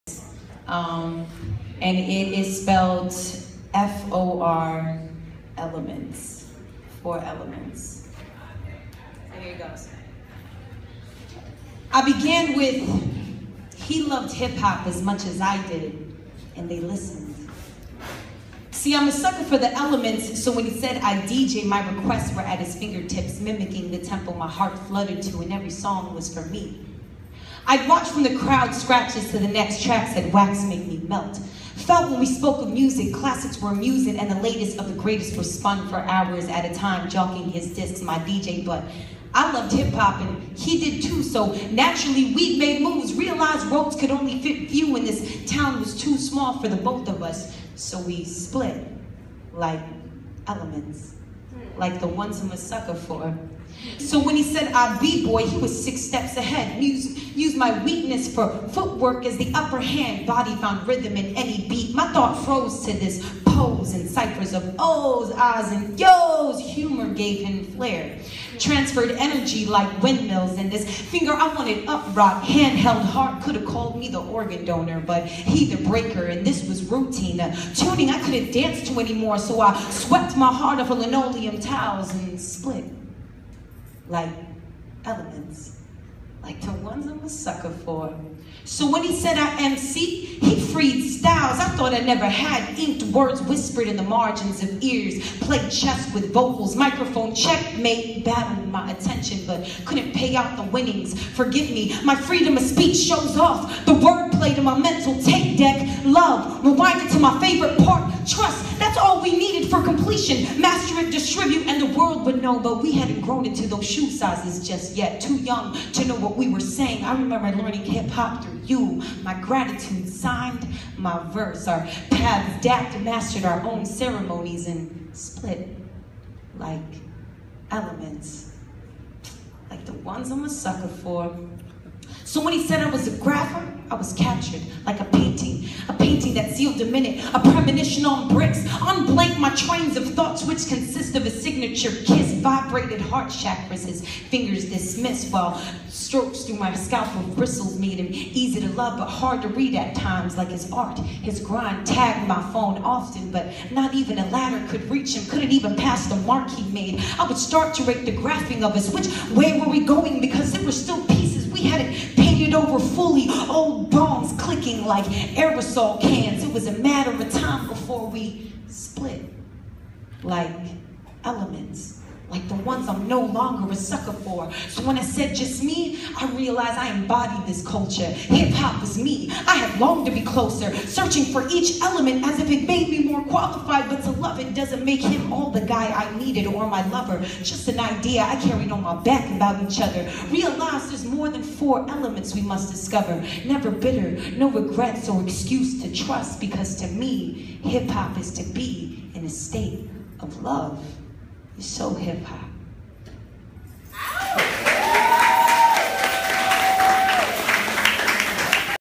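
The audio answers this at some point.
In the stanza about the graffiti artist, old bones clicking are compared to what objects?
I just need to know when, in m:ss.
2:45.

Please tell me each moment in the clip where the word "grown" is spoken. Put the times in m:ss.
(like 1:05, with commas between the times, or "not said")
1:53.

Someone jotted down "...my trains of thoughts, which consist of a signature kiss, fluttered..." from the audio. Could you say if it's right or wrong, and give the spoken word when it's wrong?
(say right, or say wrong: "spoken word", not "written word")
wrong: "vibrated", not "fluttered".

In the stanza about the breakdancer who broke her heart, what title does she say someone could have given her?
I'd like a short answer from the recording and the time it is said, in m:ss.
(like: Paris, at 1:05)
the organ donor, at 1:14.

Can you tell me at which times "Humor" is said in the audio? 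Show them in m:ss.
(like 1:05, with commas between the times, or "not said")
1:06.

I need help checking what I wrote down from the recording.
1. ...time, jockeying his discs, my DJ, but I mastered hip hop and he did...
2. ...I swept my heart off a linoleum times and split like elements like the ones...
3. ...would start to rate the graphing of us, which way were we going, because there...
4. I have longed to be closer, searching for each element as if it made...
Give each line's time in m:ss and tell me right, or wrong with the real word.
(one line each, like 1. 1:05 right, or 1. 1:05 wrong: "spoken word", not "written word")
1. 0:36 wrong: "loved", not "mastered"
2. 1:19 wrong: "tiles", not "times"
3. 2:37 right
4. 2:59 right.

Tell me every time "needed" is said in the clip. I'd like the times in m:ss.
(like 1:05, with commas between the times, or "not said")
1:49, 3:06.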